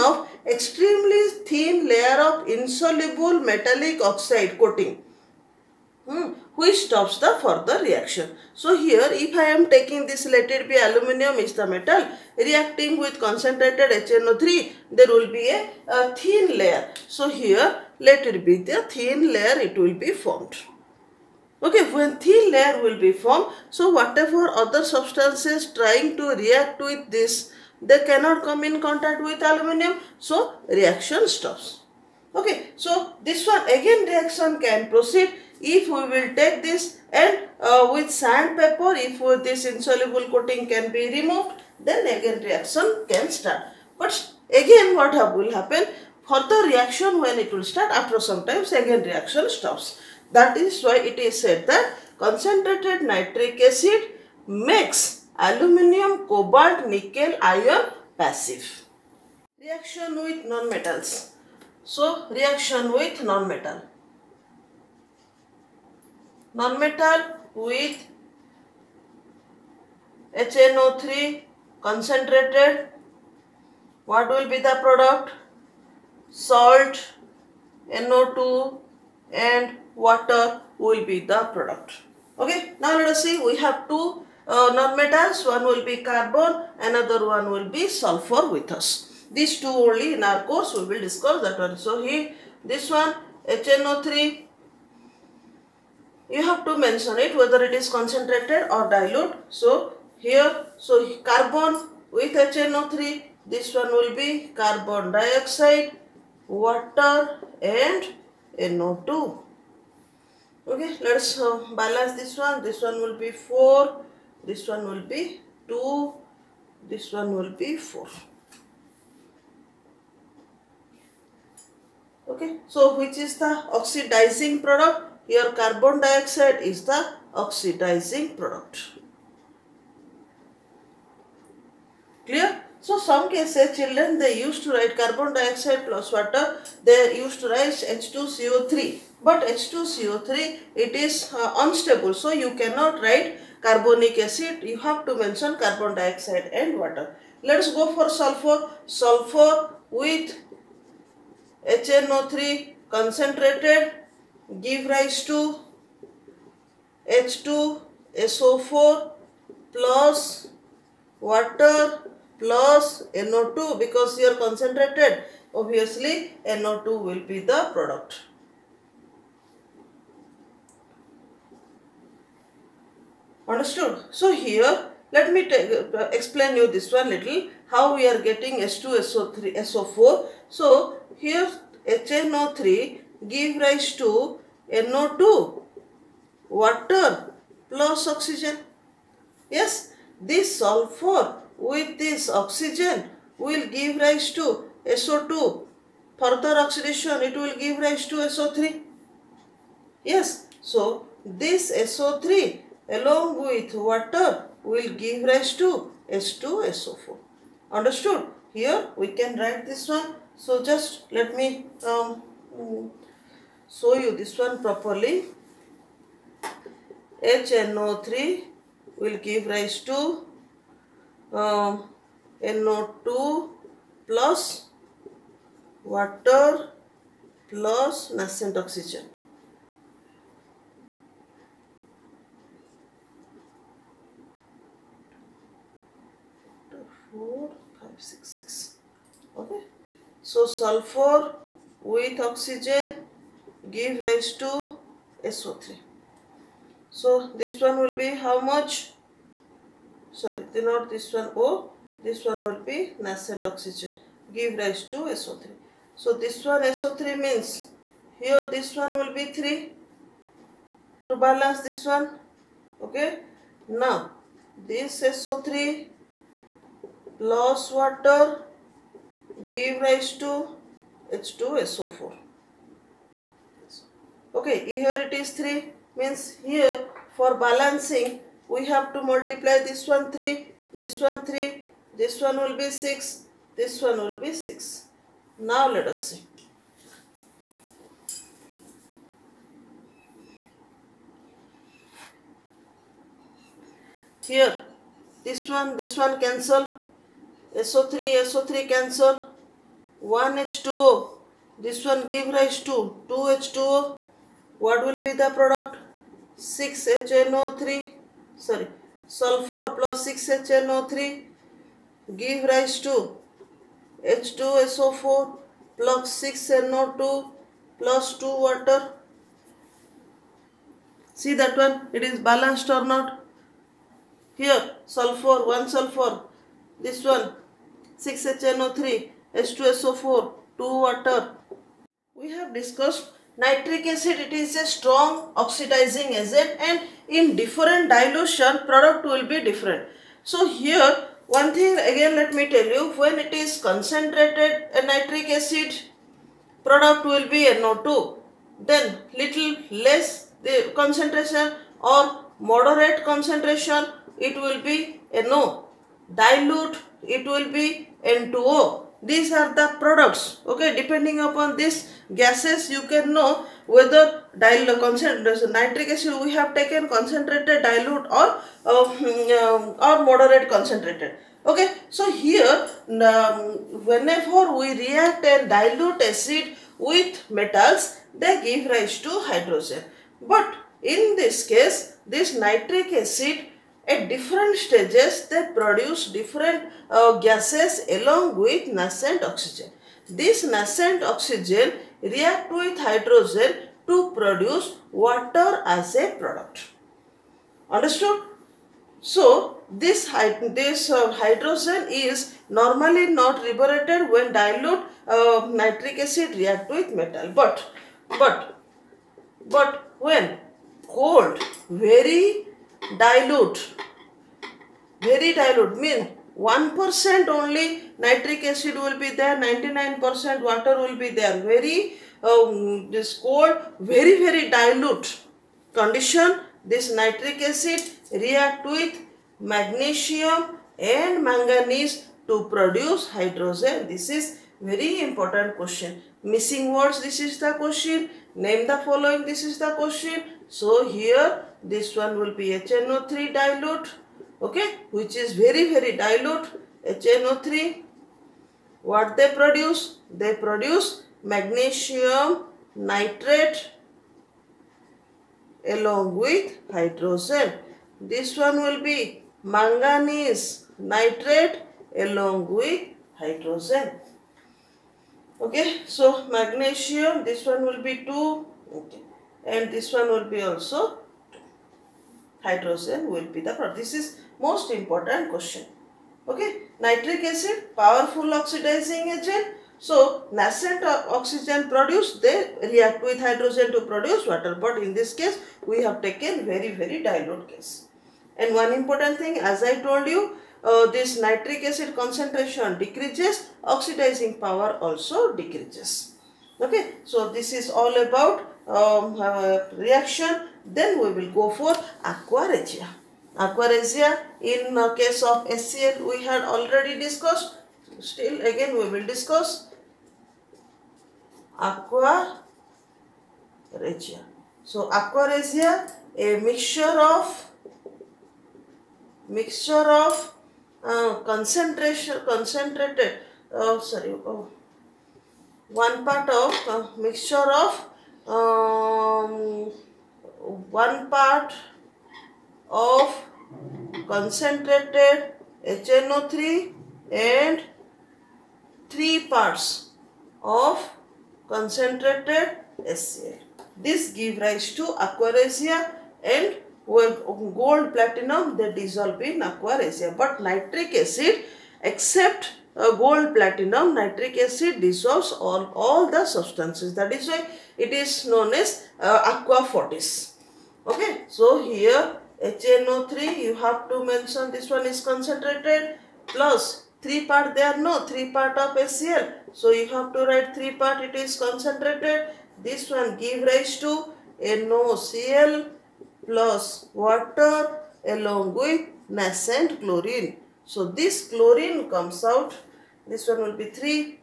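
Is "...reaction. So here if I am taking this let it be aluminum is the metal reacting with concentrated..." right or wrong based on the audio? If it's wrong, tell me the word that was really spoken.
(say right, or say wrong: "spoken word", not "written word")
right.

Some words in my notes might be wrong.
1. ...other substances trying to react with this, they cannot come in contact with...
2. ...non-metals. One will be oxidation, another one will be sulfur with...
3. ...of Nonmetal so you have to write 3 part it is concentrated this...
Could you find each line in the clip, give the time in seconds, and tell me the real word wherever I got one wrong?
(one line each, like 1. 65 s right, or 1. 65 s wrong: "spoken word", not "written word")
1. 24 s right
2. 84 s wrong: "carbon", not "oxidation"
3. 568 s wrong: "HCl", not "Nonmetal".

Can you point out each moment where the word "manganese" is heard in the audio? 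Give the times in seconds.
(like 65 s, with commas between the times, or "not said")
431 s, 459 s.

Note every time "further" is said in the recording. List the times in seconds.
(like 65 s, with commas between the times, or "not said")
7 s, 196 s.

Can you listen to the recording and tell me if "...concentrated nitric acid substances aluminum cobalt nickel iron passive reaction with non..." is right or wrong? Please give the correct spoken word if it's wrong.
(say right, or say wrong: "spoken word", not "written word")
wrong: "makes", not "substances".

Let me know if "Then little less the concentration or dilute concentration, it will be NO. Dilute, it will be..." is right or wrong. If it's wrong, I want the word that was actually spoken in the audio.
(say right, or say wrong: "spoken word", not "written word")
wrong: "moderate", not "dilute".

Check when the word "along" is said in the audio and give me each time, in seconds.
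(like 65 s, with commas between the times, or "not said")
202 s, 387 s, 455 s, 462 s, 578 s.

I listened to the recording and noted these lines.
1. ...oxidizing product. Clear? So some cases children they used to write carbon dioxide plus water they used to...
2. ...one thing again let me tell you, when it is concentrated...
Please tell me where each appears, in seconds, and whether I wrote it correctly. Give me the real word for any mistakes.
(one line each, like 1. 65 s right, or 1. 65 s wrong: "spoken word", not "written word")
1. 127 s right
2. 341 s right.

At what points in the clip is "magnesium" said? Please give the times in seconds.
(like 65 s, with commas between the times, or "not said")
429 s, 451 s, 466 s.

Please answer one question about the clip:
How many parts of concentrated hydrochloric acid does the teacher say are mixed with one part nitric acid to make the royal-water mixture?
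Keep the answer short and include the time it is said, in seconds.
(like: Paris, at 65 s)
3, at 538 s.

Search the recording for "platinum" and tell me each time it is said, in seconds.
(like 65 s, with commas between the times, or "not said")
547 s, 553 s.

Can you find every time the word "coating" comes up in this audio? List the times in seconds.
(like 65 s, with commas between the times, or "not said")
4 s, 40 s.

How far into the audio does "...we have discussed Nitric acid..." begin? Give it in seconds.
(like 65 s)
332 s.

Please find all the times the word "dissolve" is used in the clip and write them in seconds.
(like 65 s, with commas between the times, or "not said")
548 s, 554 s.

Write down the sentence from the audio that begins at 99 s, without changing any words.
So here, so carbon with HNO3, this one will be carbon dioxide, water and NO2.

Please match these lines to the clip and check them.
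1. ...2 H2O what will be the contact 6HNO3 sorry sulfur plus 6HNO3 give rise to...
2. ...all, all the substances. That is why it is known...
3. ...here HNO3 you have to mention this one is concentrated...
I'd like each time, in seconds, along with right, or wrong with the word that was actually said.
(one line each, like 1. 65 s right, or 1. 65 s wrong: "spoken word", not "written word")
1. 303 s wrong: "product", not "contact"
2. 555 s right
3. 561 s right.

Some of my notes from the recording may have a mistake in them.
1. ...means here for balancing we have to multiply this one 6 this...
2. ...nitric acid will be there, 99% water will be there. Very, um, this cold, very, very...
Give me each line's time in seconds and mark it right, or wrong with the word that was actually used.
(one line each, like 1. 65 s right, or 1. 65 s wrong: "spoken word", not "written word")
1. 276 s wrong: "3", not "6"
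2. 417 s right.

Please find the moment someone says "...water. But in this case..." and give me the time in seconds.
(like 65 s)
484 s.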